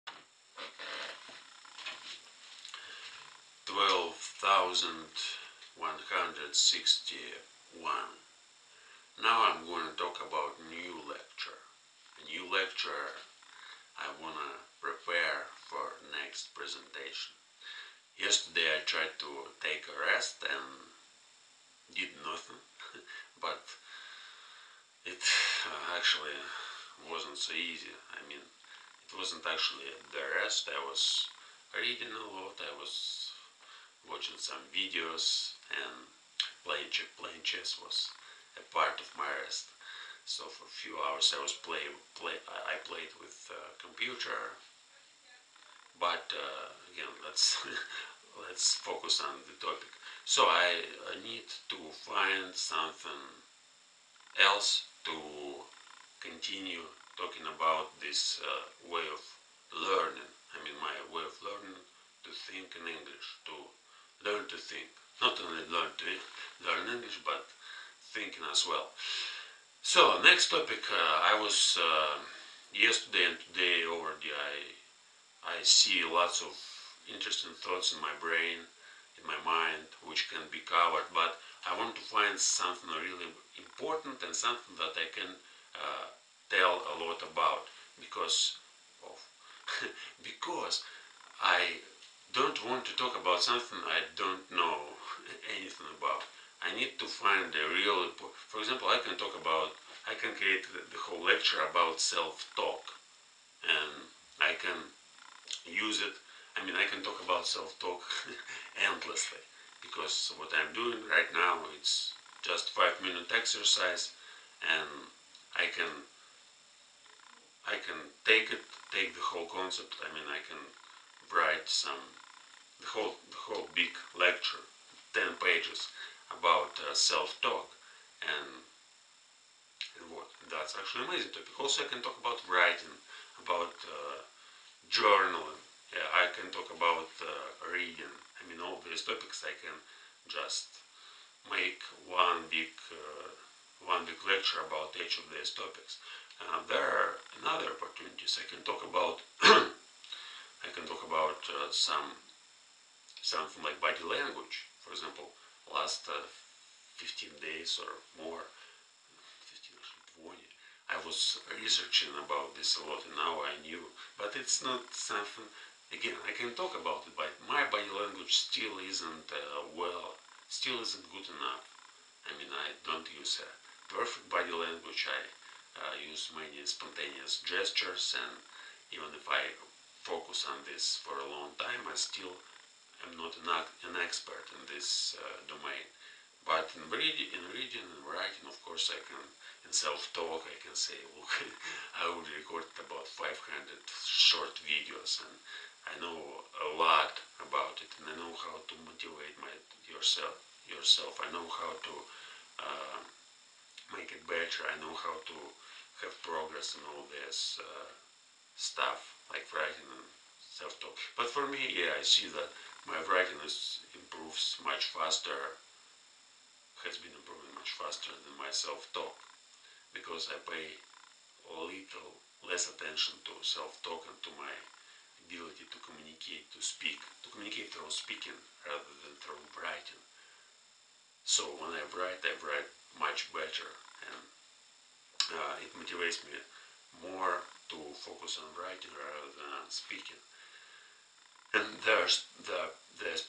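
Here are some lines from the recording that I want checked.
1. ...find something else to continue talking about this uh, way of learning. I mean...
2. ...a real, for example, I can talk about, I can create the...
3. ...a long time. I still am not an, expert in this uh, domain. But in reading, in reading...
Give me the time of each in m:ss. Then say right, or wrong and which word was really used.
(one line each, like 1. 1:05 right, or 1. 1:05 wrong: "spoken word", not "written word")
1. 0:52 right
2. 1:37 right
3. 3:01 right.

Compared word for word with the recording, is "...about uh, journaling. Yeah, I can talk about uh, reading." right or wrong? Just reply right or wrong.
right.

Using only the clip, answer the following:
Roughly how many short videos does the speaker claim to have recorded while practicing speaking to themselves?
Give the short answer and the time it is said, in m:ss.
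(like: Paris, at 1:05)
500, at 3:13.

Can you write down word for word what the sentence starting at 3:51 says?
So when I write, I write much better and uh, it motivates me more to focus on writing rather than speaking.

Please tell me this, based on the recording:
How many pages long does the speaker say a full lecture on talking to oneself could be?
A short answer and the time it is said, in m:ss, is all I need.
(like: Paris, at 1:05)
10 pages, at 2:05.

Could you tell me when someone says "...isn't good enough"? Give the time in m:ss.
2:50.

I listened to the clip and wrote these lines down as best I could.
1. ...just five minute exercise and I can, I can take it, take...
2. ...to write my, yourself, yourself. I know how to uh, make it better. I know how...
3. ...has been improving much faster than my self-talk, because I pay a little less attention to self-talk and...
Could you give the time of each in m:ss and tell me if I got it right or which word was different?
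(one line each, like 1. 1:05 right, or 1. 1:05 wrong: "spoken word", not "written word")
1. 1:52 right
2. 3:18 wrong: "motivate", not "write"
3. 3:36 right.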